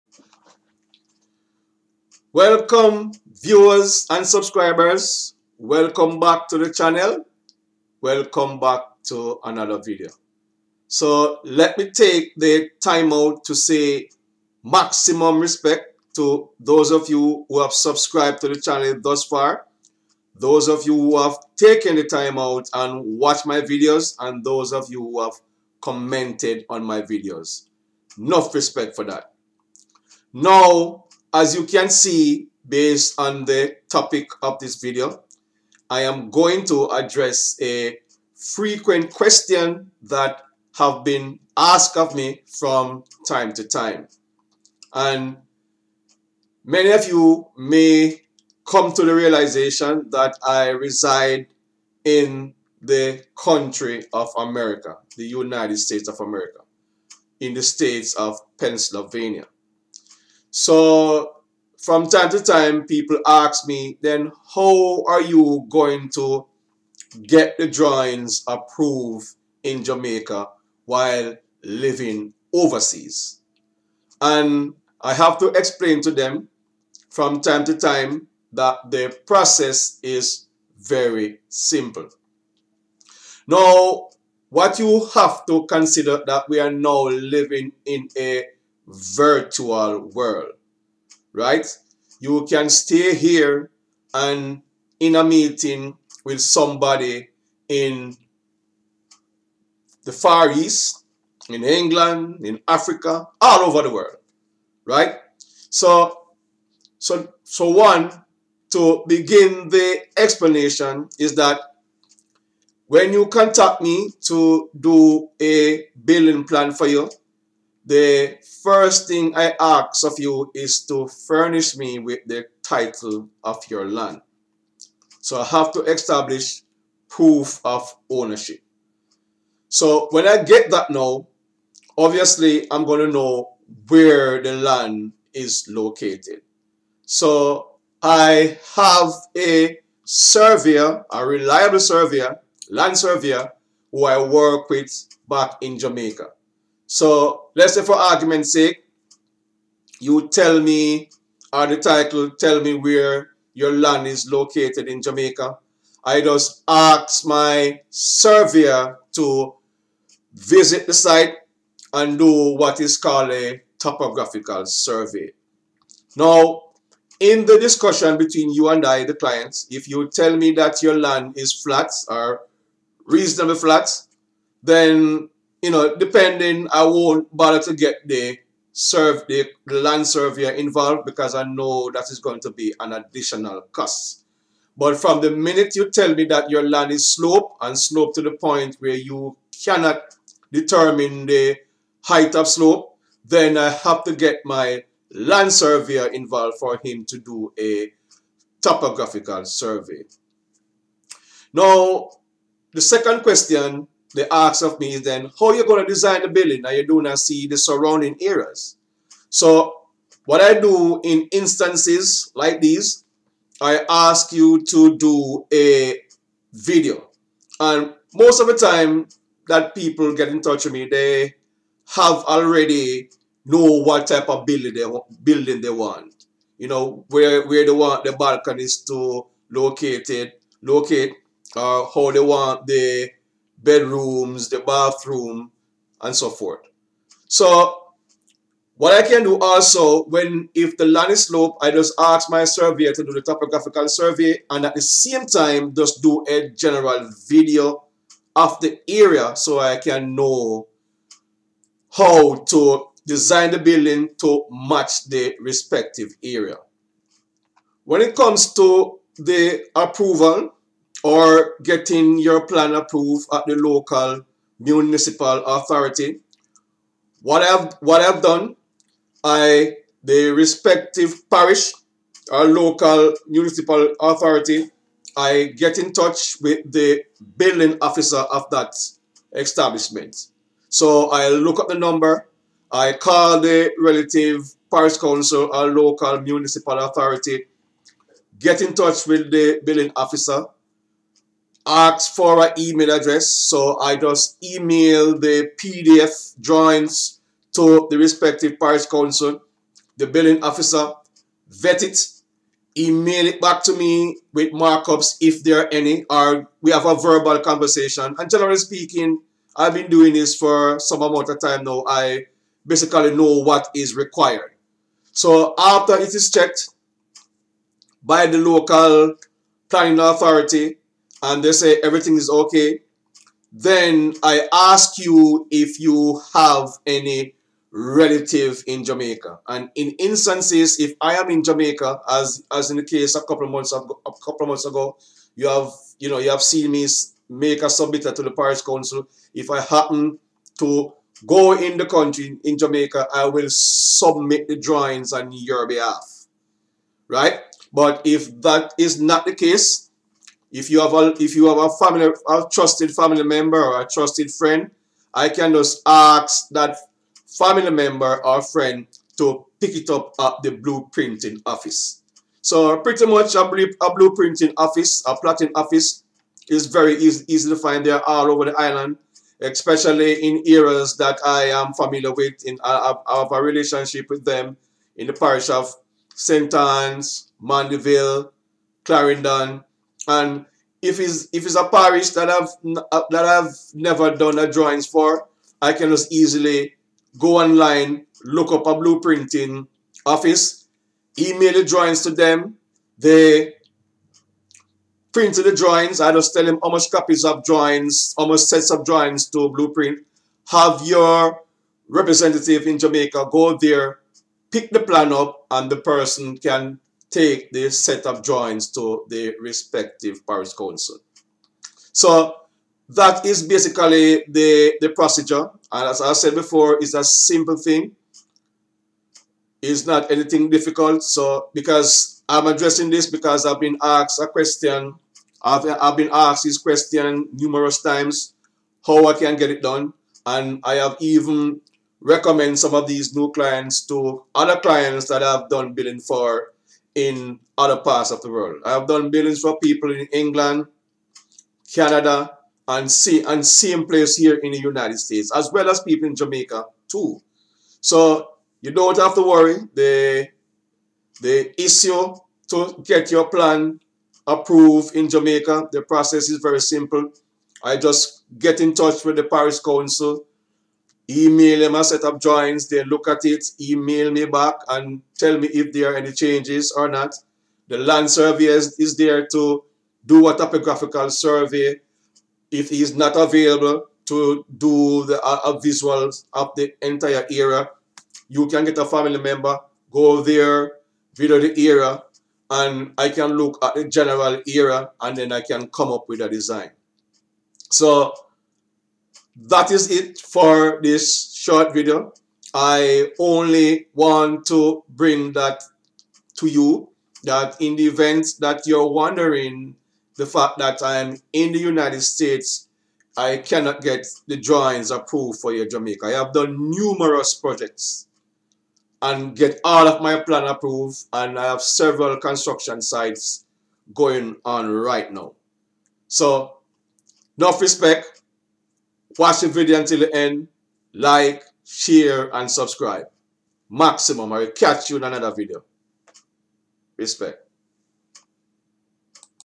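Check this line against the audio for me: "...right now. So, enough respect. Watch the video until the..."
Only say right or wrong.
right.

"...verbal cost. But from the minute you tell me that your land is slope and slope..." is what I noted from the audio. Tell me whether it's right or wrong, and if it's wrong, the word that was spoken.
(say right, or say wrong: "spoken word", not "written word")
wrong: "additional", not "verbal".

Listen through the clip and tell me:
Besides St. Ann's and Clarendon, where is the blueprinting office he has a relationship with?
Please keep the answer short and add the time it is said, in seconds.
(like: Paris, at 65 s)
Mandeville, at 377 s.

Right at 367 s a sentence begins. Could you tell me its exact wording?
There are all over the island, especially in areas that I am familiar with.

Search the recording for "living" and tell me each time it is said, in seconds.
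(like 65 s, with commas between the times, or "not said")
71 s, 87 s.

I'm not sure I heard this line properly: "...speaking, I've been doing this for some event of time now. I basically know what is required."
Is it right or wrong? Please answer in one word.
wrong.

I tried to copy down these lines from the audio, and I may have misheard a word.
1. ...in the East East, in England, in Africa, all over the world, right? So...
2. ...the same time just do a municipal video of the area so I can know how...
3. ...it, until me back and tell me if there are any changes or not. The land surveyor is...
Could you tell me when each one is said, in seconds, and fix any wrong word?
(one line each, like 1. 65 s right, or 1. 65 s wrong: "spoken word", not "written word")
1. 97 s wrong: "Far", not "East"
2. 244 s wrong: "general", not "municipal"
3. 463 s wrong: "email", not "until".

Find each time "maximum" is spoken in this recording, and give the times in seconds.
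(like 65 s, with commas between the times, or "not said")
14 s, 523 s.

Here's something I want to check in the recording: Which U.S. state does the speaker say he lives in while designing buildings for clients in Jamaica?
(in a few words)
Pennsylvania.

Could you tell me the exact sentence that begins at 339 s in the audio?
If I happen to go in the country in Jamaica, I will submit the drawings on your behalf, right?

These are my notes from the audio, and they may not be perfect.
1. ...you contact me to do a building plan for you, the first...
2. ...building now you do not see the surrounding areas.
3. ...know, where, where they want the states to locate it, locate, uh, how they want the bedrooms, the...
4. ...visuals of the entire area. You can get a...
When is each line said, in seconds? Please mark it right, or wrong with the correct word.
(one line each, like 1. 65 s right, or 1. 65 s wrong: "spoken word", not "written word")
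1. 113 s right
2. 206 s right
3. 226 s wrong: "balconies", not "states"
4. 475 s right.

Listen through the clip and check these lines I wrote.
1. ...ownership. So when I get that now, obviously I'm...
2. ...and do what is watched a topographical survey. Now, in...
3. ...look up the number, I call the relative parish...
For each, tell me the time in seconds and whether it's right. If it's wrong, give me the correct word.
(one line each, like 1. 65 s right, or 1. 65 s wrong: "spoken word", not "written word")
1. 128 s right
2. 161 s wrong: "called", not "watched"
3. 281 s right.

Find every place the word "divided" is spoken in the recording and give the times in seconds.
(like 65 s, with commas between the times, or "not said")
not said.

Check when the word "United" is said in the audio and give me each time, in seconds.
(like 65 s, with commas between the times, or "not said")
55 s, 444 s, 501 s.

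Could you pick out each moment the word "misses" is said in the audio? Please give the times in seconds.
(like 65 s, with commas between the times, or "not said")
not said.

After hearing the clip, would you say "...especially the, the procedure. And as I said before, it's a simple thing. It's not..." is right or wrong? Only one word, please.
wrong.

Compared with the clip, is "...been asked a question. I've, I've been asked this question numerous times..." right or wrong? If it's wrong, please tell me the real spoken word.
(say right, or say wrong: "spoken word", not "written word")
right.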